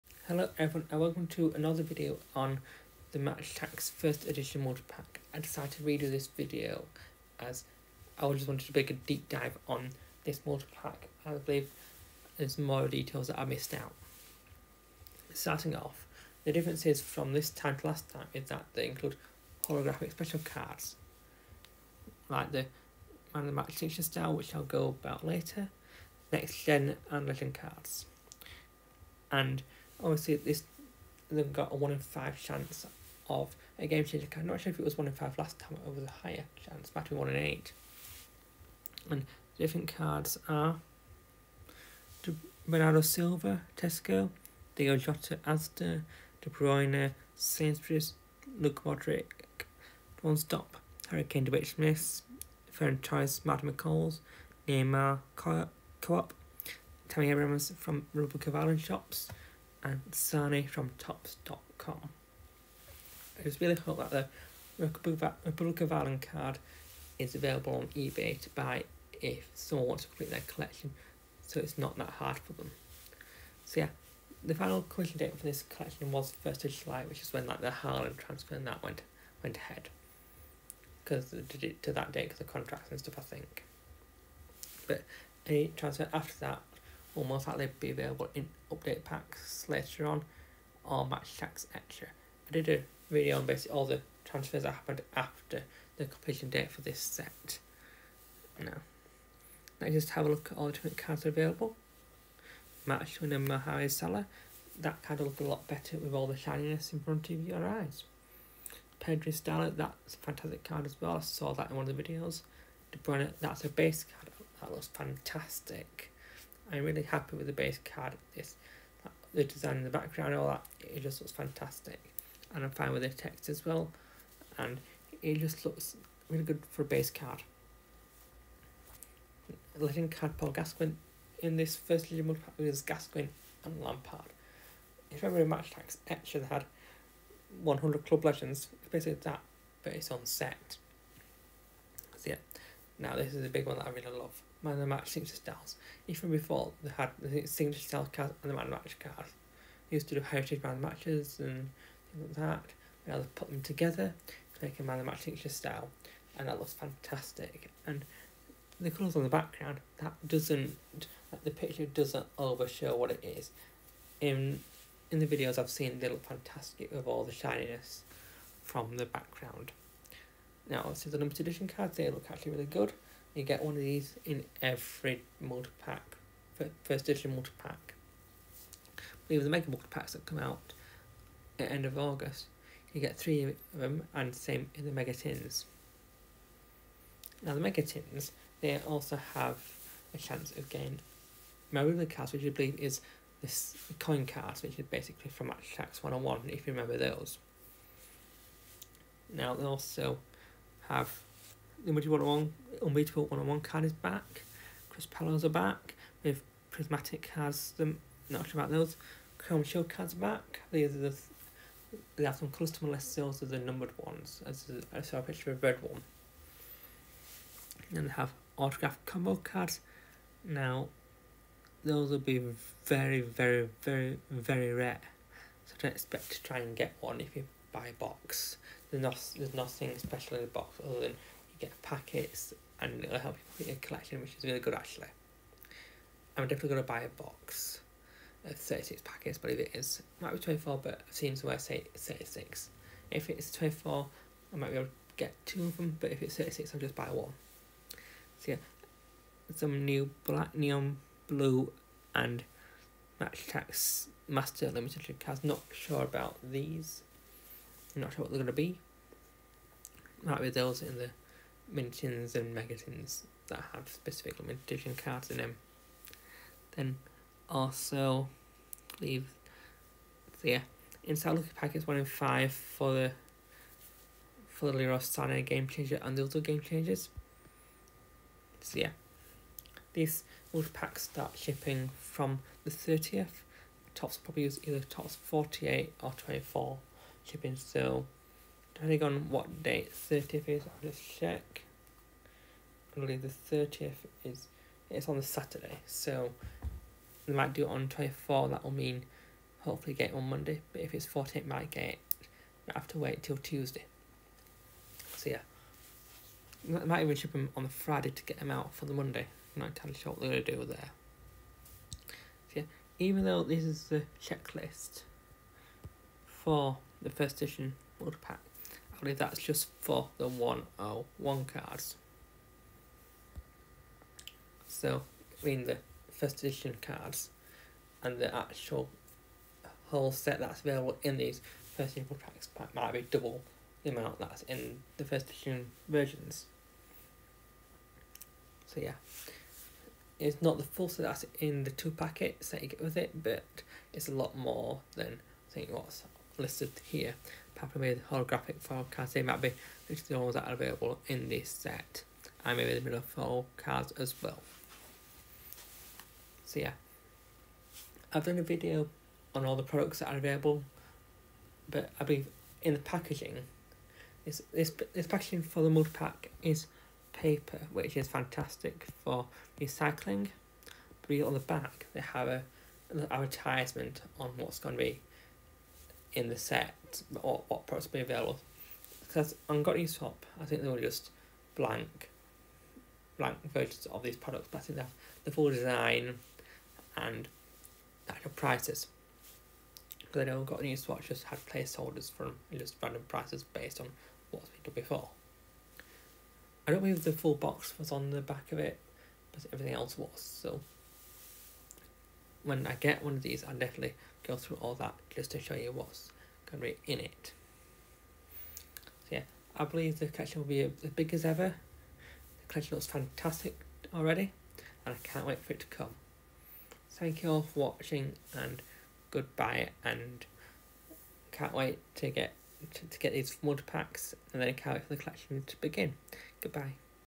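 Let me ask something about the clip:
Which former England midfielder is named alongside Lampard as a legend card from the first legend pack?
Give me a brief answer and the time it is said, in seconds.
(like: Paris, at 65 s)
Paul Gascoigne, at 130 s.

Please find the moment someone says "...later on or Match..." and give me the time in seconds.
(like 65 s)
89 s.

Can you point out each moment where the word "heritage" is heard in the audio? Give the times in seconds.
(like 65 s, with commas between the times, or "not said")
150 s.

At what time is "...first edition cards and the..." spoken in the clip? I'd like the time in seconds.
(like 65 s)
326 s.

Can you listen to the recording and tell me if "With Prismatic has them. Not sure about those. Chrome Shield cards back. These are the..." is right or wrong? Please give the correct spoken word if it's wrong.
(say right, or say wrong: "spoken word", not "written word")
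right.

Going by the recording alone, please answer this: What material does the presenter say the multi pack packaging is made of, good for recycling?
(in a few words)
Paper.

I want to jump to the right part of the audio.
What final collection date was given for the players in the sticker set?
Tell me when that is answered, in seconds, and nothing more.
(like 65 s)
76 s.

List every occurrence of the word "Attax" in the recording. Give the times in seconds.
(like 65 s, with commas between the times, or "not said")
3 s, 91 s, 135 s, 195 s, 253 s.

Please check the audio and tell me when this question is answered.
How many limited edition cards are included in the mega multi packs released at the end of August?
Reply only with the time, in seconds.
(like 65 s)
183 s.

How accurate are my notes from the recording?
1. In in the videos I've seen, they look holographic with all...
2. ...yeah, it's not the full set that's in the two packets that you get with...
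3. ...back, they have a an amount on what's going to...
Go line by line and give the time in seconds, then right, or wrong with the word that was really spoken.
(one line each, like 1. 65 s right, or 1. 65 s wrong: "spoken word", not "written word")
1. 164 s wrong: "fantastic", not "holographic"
2. 338 s right
3. 371 s wrong: "advertisement", not "amount".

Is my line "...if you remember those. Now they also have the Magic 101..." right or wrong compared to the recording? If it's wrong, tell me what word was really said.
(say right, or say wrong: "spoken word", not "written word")
right.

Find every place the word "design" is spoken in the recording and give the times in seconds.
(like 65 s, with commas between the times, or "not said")
119 s, 385 s.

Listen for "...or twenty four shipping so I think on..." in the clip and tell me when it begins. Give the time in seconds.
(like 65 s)
286 s.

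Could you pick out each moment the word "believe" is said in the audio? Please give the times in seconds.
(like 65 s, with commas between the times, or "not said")
11 s, 192 s, 292 s, 362 s, 396 s, 409 s.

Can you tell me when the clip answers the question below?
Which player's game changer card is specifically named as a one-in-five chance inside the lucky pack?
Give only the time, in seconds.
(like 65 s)
274 s.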